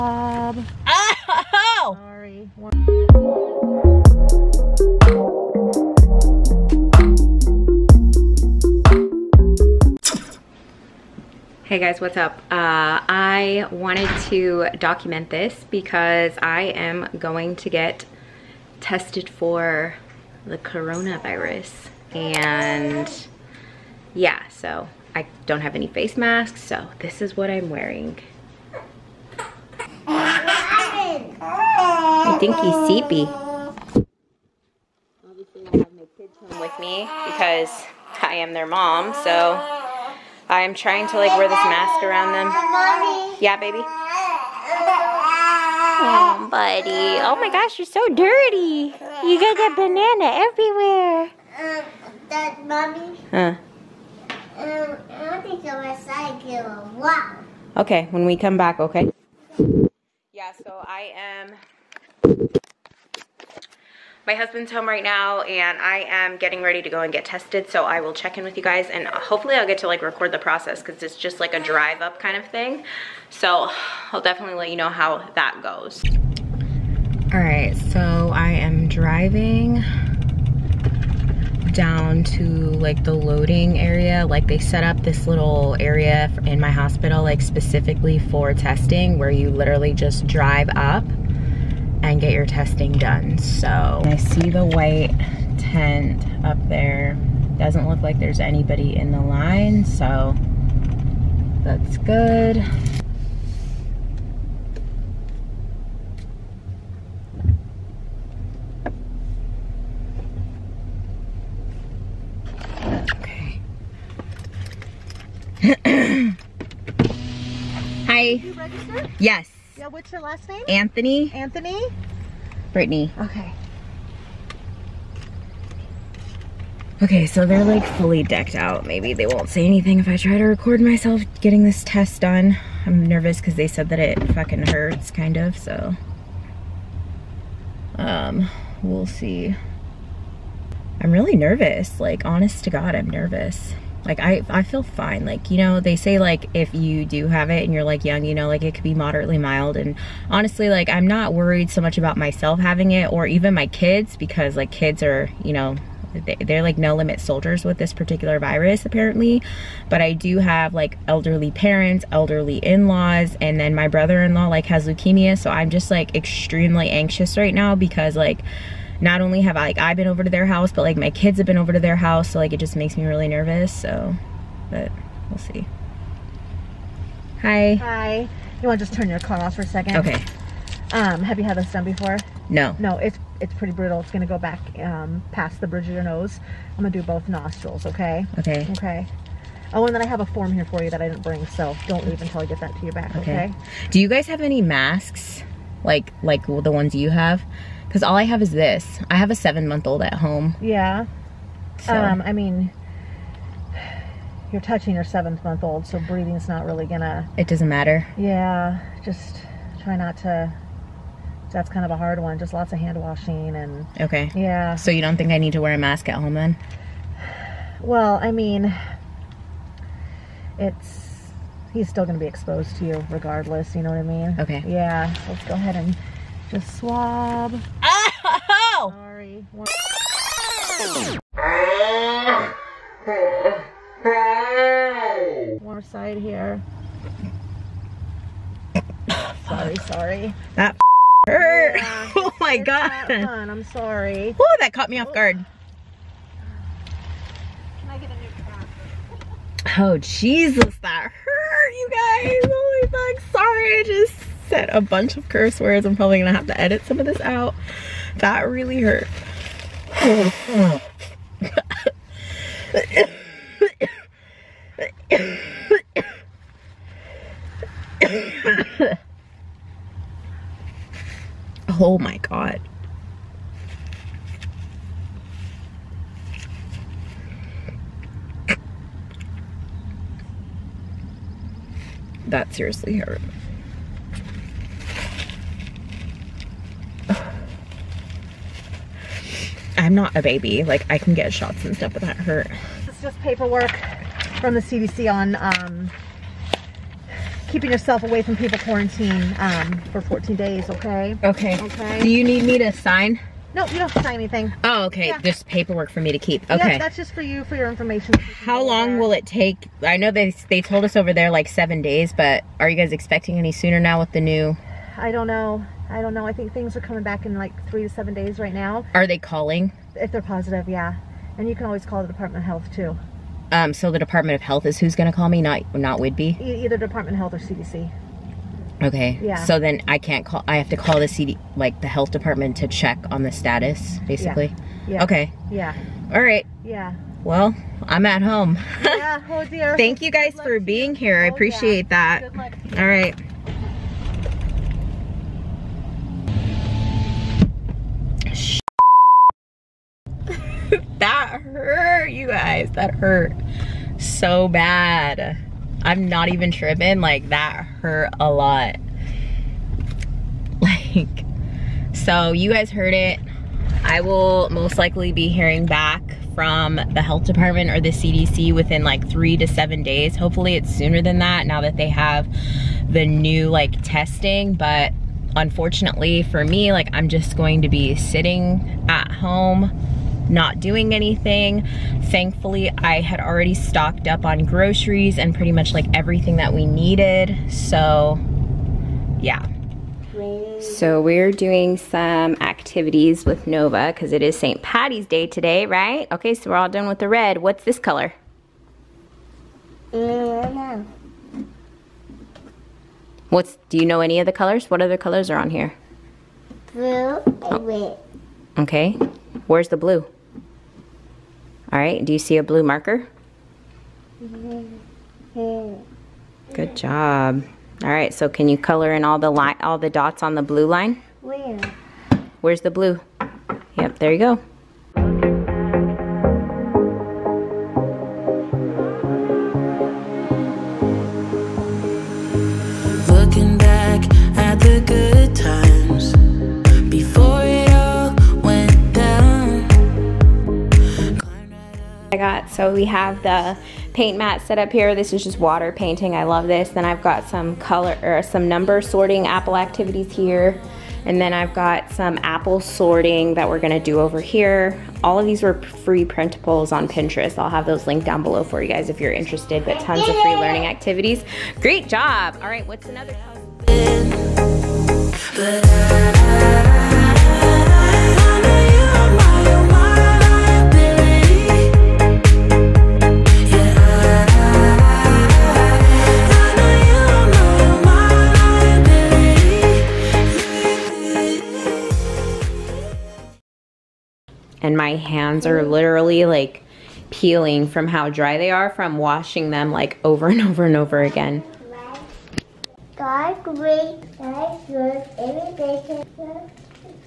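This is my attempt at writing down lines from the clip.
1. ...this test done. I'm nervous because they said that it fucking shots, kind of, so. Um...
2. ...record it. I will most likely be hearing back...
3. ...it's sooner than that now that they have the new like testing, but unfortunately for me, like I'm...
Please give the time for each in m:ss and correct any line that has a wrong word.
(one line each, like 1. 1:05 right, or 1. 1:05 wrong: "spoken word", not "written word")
1. 2:11 wrong: "hurts", not "shots"
2. 6:02 wrong: "heard", not "record"
3. 6:10 right.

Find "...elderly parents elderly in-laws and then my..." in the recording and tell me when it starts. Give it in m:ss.
2:41.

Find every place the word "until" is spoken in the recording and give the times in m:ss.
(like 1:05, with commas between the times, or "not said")
3:12.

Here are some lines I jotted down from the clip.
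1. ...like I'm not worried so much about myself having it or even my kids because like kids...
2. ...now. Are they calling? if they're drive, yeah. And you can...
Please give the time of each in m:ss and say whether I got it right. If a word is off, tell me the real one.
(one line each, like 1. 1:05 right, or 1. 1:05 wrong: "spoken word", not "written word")
1. 2:30 right
2. 5:18 wrong: "positive", not "drive".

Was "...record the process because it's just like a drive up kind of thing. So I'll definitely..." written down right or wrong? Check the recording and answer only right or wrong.
right.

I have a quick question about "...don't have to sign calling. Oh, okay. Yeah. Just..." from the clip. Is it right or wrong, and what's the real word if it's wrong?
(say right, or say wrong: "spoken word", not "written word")
wrong: "anything", not "calling".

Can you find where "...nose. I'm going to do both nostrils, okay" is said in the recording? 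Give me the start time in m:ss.
3:06.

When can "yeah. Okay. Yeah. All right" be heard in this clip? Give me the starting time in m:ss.
5:34.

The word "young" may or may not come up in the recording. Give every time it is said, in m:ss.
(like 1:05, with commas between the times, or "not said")
2:28.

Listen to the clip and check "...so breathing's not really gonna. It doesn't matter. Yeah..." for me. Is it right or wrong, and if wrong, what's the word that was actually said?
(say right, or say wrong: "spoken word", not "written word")
right.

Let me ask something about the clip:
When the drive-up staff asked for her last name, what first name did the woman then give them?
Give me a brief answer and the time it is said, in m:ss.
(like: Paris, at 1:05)
Brittany, at 2:02.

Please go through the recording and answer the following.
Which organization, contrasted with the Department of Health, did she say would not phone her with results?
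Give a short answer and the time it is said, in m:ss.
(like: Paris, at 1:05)
Whidbey, at 5:25.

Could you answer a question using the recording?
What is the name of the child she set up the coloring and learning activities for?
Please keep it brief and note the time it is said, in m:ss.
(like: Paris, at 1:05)
Nova, at 6:33.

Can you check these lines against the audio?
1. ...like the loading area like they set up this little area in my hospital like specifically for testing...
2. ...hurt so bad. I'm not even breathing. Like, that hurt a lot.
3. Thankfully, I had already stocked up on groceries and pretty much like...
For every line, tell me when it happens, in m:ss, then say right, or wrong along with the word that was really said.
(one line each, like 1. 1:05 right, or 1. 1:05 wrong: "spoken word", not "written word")
1. 1:22 right
2. 5:52 wrong: "tripping", not "breathing"
3. 6:22 right.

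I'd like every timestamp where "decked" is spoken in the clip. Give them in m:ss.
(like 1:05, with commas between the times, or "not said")
2:08.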